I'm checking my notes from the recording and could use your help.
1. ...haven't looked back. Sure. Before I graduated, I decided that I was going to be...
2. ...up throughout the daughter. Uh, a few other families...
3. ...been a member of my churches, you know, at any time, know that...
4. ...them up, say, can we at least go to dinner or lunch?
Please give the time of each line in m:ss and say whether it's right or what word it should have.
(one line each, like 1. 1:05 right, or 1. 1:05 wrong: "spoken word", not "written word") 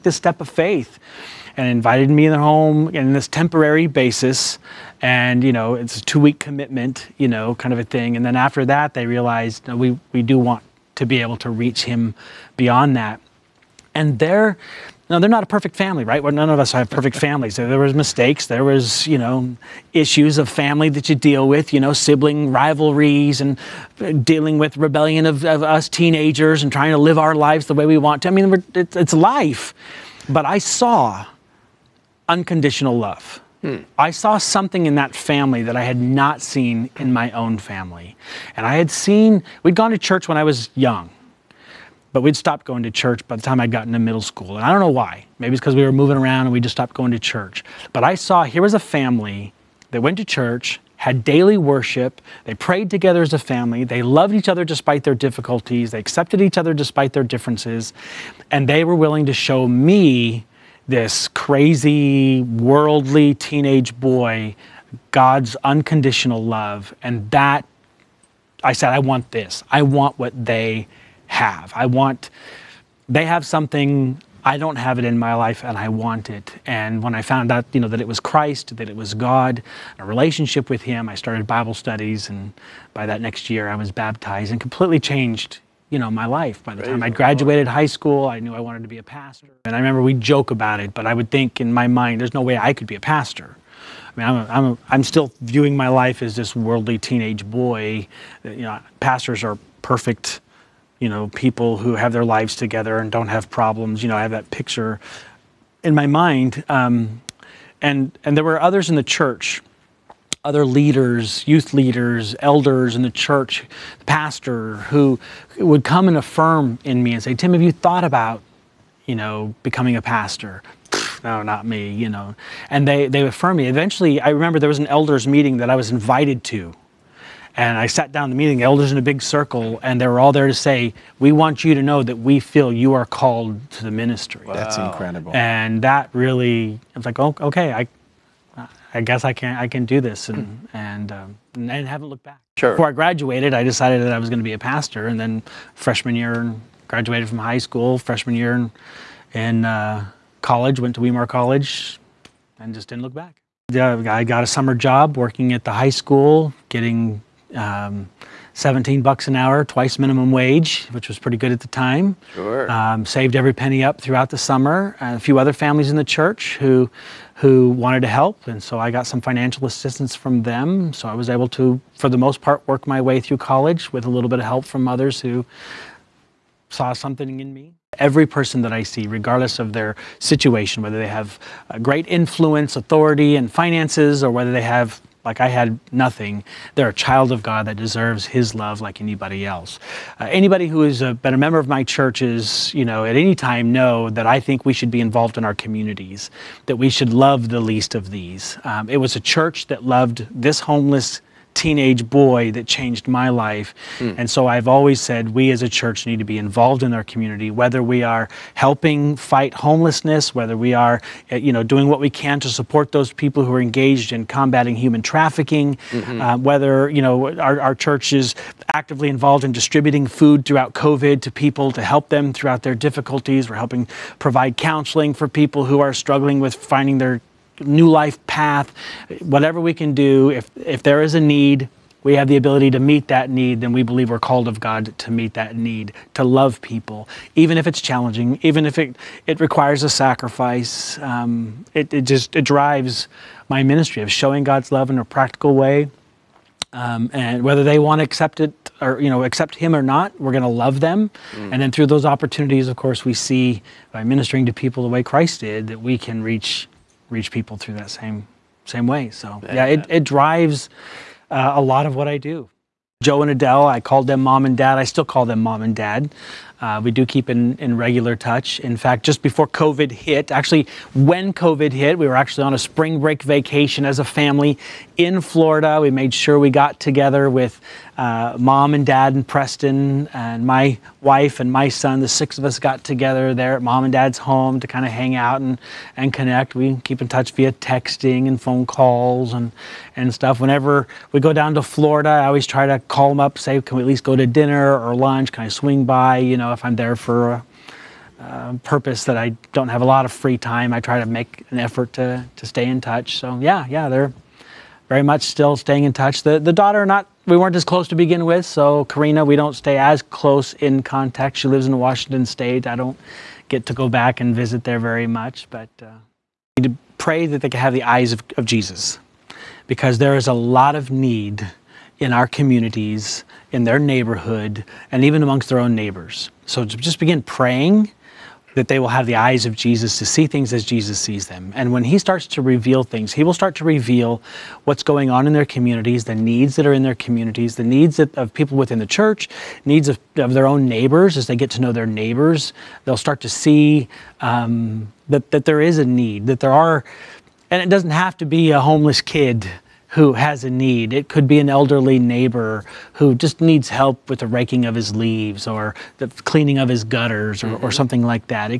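1. 2:21 right
2. 2:43 wrong: "summer", not "daughter"
3. 3:10 right
4. 4:53 right.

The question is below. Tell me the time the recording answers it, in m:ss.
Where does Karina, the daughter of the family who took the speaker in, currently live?
5:11.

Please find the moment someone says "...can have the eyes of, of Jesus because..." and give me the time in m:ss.
5:17.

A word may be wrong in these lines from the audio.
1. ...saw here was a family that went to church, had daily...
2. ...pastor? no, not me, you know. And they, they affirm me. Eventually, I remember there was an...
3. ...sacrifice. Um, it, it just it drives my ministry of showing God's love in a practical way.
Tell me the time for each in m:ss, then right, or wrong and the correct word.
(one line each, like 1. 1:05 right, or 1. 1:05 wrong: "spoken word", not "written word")
1. 0:48 right
2. 2:00 right
3. 3:59 right.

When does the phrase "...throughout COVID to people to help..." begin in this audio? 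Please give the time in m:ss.
3:40.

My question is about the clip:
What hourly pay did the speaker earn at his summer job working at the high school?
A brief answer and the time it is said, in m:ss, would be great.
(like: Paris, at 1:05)
$17, at 2:38.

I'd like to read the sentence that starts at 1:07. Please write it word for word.
And that, I said, I want this.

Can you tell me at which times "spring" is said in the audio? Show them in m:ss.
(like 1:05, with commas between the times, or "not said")
4:32.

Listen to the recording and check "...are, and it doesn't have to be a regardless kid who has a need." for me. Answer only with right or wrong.
wrong.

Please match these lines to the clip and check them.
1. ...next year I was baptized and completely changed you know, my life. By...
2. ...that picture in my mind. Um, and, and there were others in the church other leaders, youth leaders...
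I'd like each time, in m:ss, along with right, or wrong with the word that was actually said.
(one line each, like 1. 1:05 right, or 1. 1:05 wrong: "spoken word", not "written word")
1. 1:23 right
2. 1:44 right.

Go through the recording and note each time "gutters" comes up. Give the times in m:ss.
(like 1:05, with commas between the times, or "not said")
5:56.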